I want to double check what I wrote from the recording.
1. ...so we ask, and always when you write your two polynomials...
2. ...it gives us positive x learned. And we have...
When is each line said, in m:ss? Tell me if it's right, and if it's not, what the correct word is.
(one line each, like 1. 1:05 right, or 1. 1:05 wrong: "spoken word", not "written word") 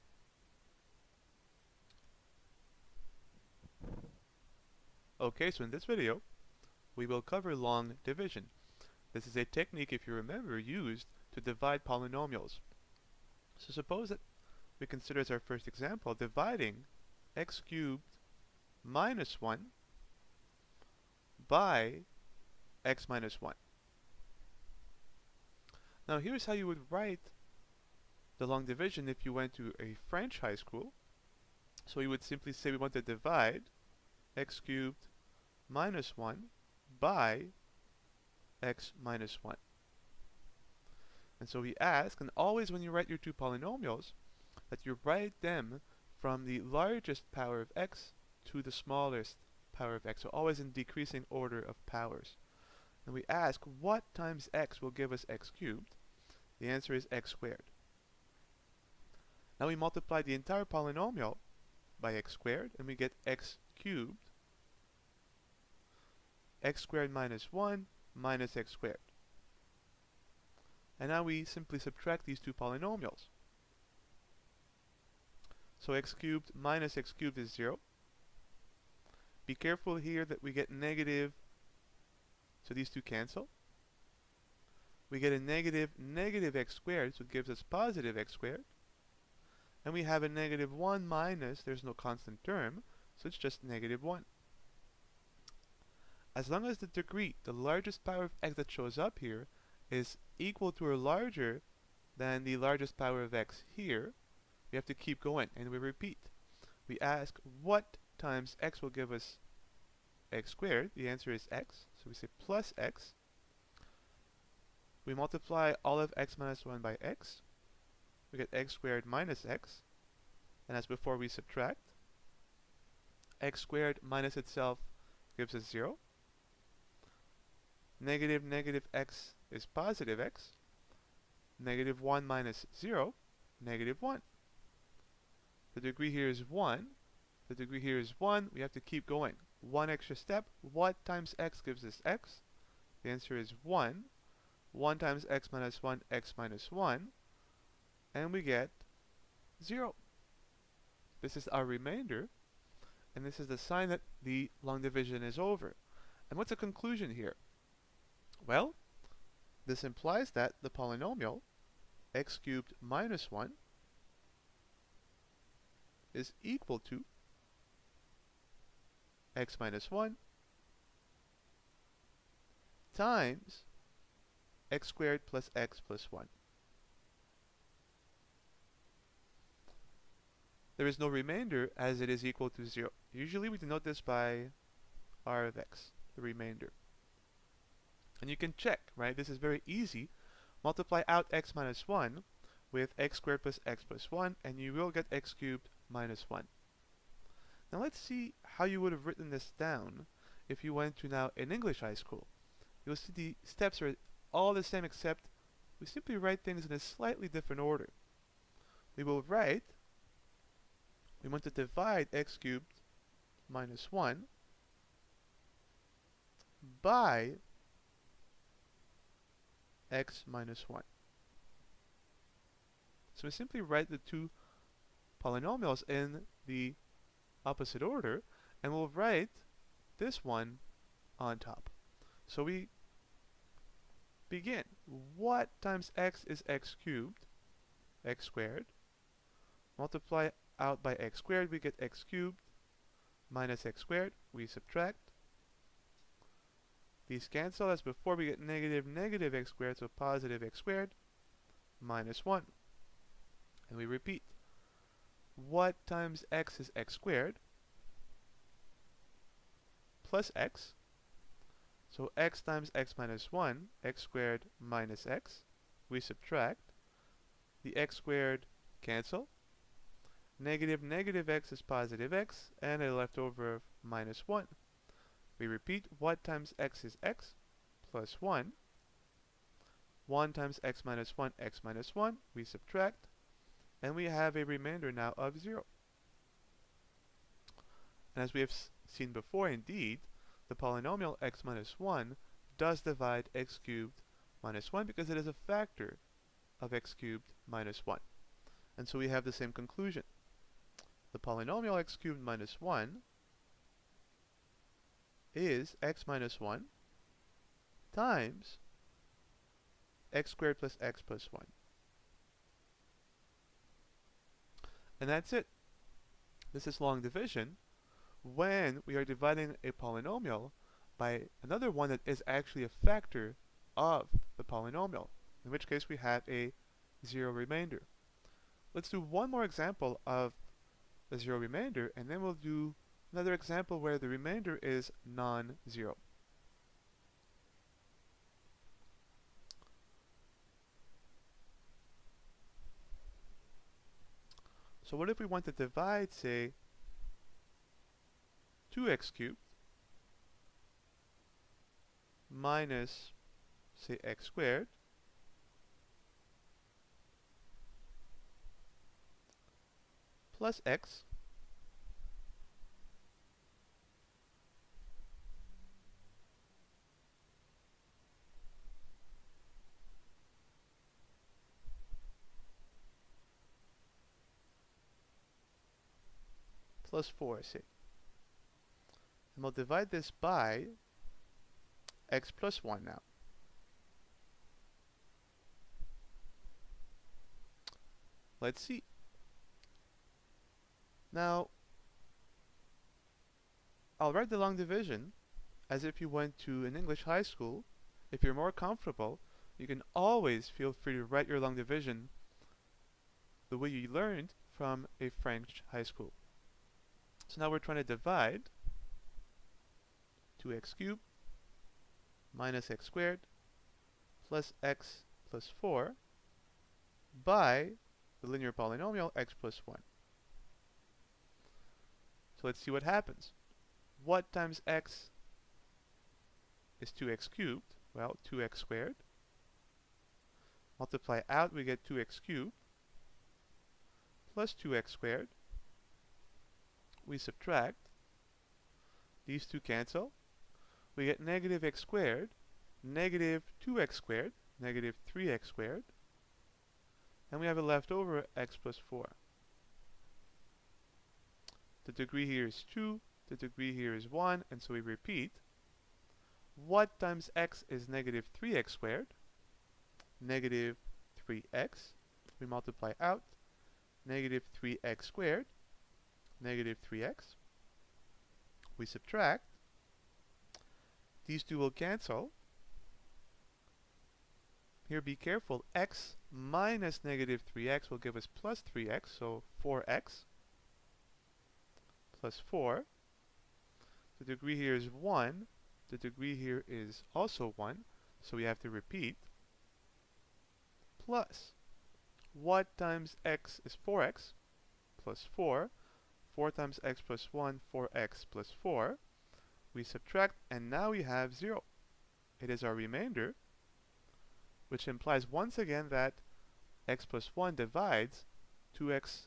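1. 0:41 right
2. 1:27 wrong: "squared", not "learned".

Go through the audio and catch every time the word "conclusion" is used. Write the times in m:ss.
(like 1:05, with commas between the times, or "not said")
2:36, 4:59.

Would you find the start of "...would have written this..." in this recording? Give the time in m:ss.
3:18.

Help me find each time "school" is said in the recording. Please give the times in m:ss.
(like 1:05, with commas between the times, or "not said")
0:30, 3:21, 6:37, 6:45.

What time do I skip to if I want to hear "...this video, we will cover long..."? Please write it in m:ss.
0:05.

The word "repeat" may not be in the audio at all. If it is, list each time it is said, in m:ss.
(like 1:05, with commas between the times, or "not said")
1:45, 4:13, 4:35, 7:34, 8:08.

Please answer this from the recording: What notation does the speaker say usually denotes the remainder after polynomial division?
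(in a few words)
r of x.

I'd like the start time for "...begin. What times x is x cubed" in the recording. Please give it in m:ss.
3:54.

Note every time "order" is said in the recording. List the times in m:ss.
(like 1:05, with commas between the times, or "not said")
0:51, 3:27, 3:47.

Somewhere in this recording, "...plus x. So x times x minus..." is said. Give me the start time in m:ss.
4:20.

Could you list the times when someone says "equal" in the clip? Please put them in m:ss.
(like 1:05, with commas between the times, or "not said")
1:40, 2:46, 3:02.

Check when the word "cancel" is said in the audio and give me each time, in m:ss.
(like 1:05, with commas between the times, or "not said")
1:23, 4:07, 4:28, 7:19, 7:51.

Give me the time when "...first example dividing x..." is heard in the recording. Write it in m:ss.
0:15.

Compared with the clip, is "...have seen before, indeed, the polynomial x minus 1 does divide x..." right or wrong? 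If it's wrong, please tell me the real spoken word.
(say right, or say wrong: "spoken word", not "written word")
right.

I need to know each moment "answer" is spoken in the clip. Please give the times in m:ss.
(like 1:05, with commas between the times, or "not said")
0:56, 1:51, 2:23.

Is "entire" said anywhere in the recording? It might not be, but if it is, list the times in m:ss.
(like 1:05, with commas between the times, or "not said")
1:00.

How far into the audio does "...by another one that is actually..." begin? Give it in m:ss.
5:20.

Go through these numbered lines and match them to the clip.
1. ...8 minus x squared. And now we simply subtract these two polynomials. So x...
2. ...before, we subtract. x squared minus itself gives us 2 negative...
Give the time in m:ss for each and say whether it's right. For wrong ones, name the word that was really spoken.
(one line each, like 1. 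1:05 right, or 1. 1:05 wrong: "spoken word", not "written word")
1. 1:07 wrong: "1", not "8"
2. 2:00 wrong: "0", not "2".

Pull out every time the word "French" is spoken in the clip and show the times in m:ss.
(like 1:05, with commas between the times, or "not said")
0:30, 6:45.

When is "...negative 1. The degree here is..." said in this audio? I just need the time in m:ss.
2:13.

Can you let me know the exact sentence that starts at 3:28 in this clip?
We will write, we want to divide x cubed minus 1 by x minus 1.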